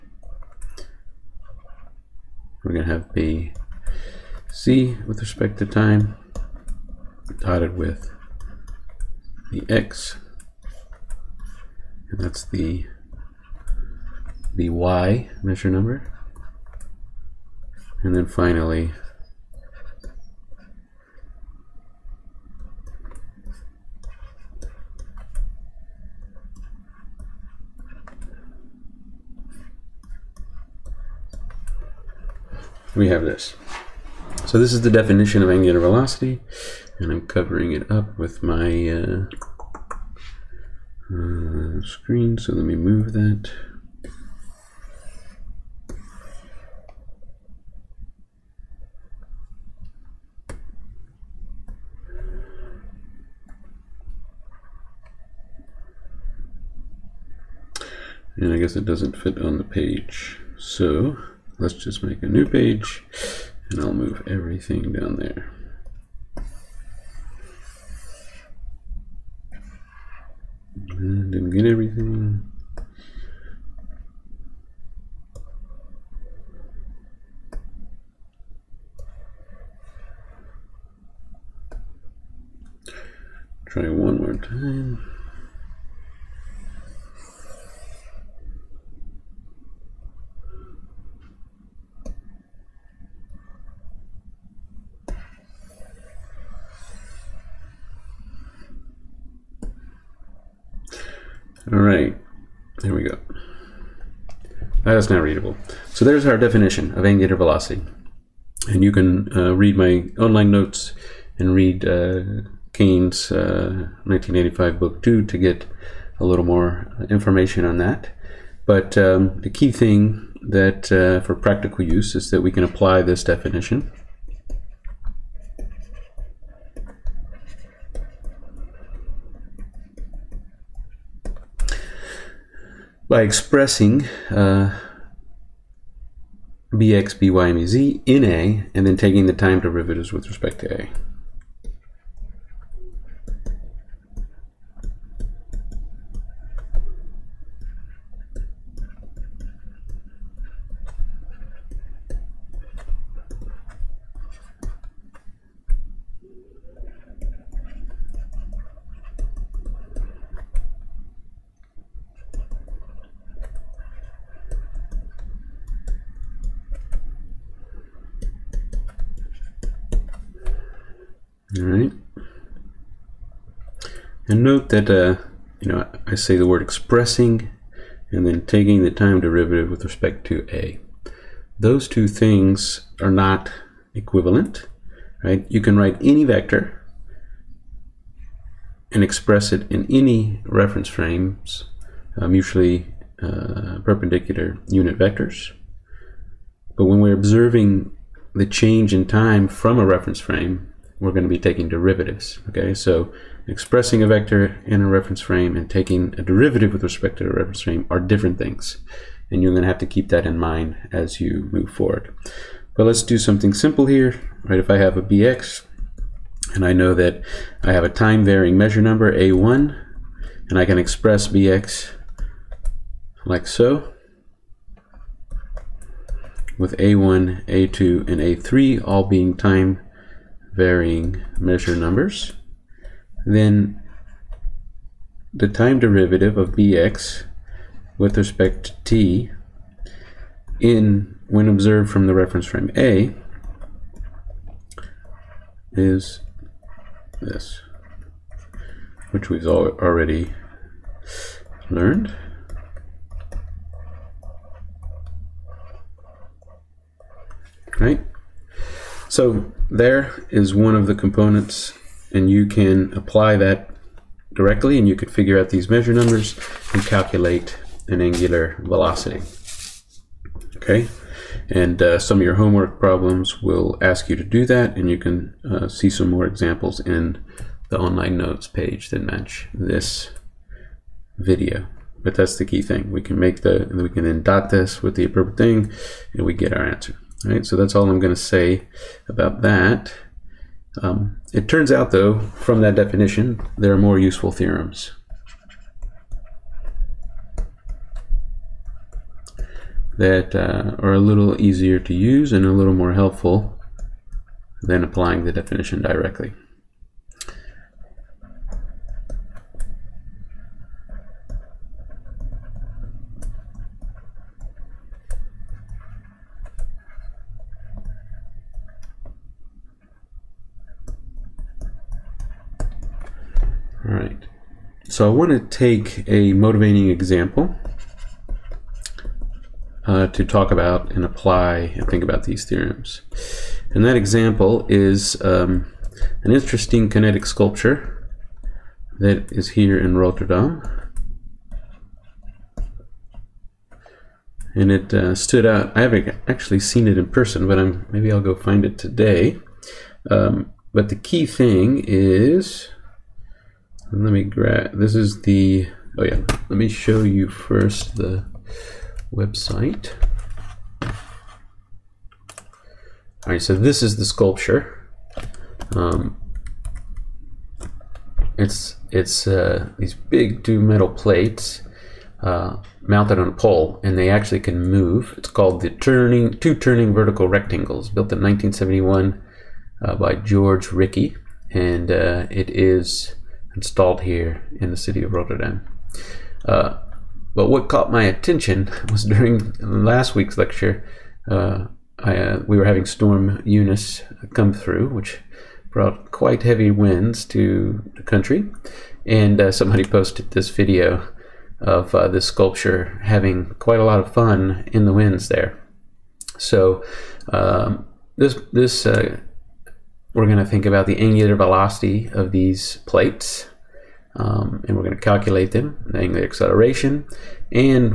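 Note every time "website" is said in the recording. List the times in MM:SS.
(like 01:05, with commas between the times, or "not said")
05:59.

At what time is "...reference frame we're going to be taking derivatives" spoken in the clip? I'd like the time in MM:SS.
03:19.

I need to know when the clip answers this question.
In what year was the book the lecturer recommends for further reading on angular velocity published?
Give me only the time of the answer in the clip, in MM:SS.
01:54.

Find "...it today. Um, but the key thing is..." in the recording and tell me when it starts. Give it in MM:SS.
05:48.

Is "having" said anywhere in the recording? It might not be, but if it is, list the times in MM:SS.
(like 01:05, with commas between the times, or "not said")
06:32, 06:43.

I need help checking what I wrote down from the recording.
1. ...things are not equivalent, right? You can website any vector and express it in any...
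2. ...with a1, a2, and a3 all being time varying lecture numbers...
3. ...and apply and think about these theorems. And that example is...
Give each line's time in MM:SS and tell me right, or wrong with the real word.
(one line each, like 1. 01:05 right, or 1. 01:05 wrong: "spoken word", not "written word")
1. 03:02 wrong: "write", not "website"
2. 03:46 wrong: "measure", not "lecture"
3. 05:30 right.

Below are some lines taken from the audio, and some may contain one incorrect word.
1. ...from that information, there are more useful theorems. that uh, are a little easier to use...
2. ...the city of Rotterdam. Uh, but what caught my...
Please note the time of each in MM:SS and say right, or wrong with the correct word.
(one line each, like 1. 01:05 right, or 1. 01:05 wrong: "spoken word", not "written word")
1. 04:52 wrong: "definition", not "information"
2. 06:24 right.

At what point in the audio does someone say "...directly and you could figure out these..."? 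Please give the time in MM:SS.
04:24.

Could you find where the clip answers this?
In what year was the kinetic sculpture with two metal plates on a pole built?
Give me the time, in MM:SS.
06:18.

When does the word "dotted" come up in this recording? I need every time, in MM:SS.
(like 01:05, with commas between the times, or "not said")
00:07.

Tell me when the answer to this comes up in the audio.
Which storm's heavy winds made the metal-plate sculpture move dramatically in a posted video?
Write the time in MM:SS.
06:32.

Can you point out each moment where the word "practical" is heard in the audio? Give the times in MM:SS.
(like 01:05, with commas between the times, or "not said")
02:01.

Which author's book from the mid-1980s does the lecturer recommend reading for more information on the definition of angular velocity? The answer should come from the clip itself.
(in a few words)
Kane.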